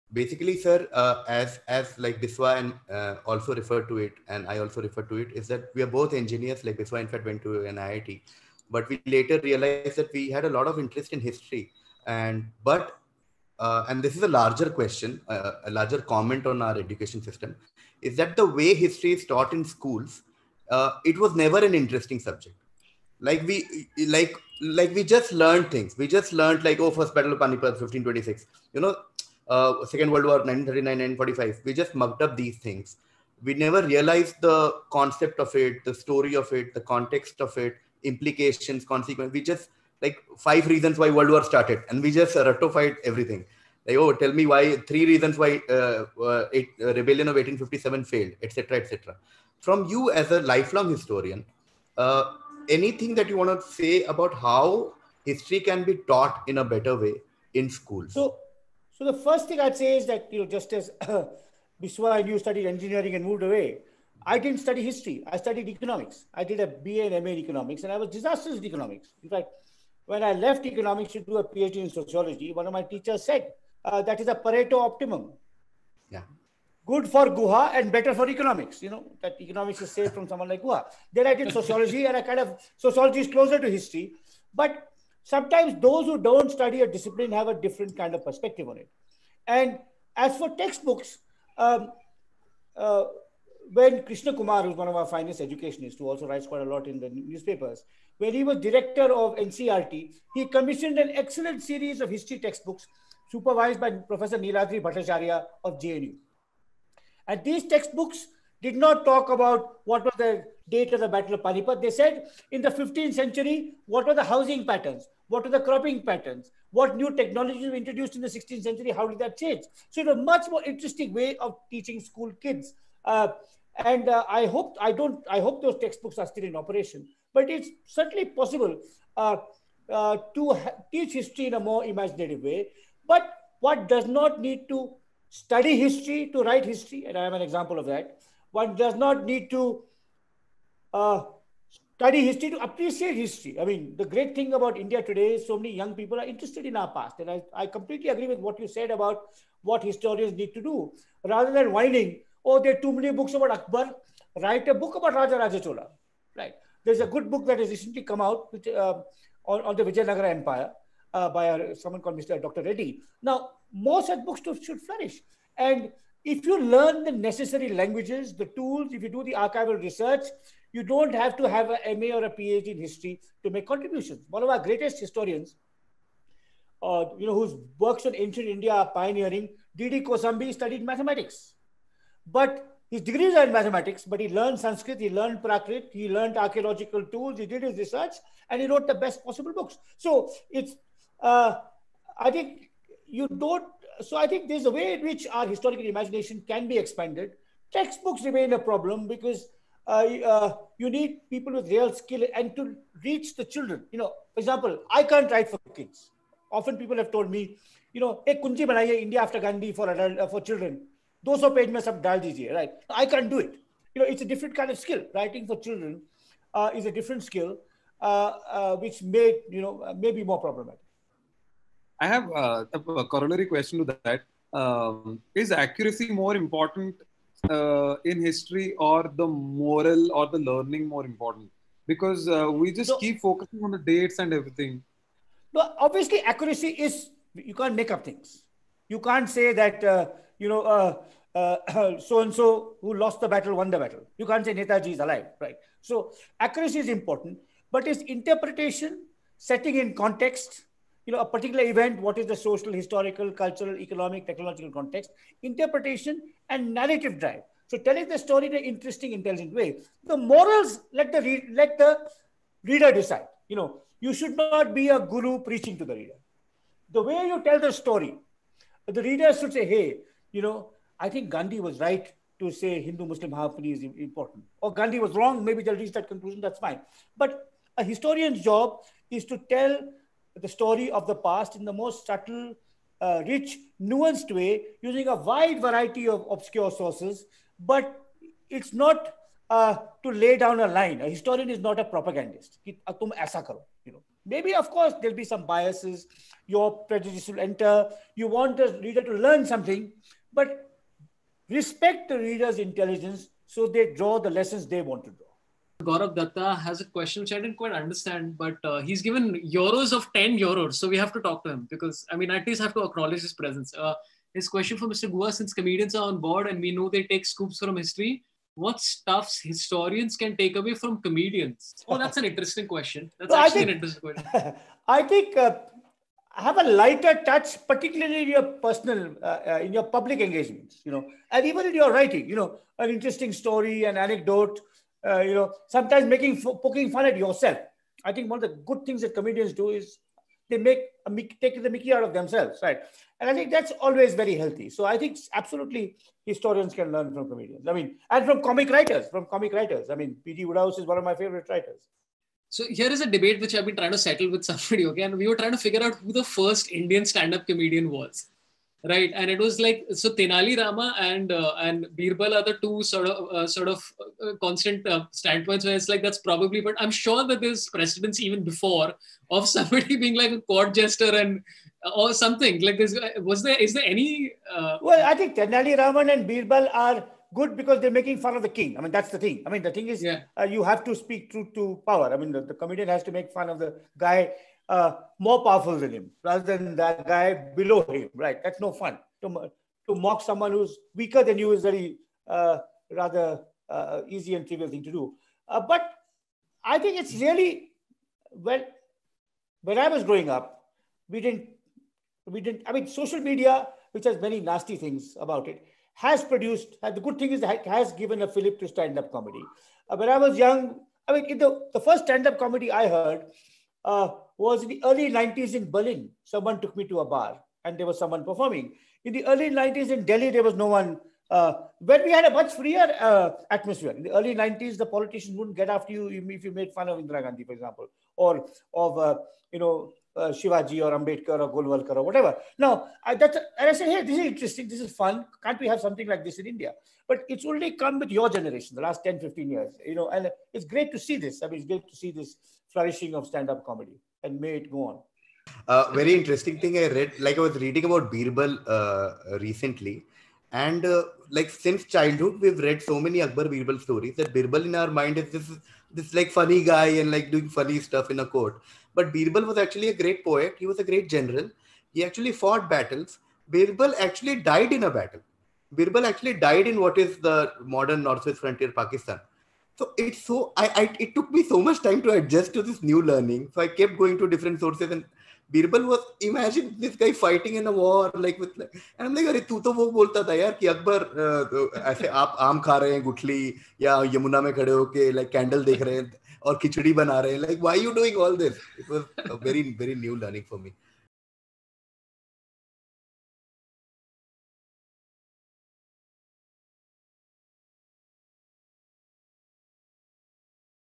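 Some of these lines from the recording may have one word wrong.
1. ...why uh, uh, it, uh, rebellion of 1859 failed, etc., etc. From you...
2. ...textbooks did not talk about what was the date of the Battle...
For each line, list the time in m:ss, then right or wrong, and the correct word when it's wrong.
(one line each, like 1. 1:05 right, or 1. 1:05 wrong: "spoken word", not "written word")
1. 0:45 wrong: "1857", not "1859"
2. 1:47 right.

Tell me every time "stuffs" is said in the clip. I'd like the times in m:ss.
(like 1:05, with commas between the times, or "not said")
5:18, 7:37.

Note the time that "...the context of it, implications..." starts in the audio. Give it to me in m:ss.
0:36.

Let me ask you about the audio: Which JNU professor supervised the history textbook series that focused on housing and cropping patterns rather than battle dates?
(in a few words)
Niladri Bhattacharya.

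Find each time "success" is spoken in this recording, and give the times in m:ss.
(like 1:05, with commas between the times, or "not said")
not said.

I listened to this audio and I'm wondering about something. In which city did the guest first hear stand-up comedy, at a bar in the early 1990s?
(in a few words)
Berlin.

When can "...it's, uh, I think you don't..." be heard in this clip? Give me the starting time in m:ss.
3:10.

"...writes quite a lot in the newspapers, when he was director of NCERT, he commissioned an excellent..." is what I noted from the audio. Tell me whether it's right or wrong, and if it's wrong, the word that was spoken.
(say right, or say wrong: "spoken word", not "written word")
right.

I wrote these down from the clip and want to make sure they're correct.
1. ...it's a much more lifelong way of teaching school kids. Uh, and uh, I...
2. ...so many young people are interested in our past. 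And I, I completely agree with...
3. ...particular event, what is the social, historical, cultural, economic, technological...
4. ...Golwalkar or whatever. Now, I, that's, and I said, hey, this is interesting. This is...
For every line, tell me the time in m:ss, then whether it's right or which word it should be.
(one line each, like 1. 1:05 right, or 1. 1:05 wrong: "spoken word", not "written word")
1. 2:00 wrong: "interesting", not "lifelong"
2. 2:25 right
3. 4:11 right
4. 7:11 right.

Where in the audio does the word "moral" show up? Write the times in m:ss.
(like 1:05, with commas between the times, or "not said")
3:49, 4:20.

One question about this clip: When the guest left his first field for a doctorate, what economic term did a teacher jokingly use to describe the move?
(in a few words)
Pareto optimum.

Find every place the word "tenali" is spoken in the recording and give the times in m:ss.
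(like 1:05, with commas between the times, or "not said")
6:00, 6:15.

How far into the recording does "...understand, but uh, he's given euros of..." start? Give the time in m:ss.
5:07.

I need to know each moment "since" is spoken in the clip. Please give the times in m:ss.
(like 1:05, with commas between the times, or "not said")
5:15, 7:31.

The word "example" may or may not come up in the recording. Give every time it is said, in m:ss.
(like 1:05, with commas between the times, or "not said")
2:17, 3:24, 7:07.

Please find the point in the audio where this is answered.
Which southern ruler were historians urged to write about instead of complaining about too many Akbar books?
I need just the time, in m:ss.
2:35.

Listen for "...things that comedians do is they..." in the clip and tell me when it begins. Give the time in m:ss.
5:38.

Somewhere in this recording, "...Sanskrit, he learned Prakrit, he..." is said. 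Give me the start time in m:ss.
3:04.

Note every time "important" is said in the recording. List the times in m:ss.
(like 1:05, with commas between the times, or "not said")
3:46, 3:51, 4:06, 4:33.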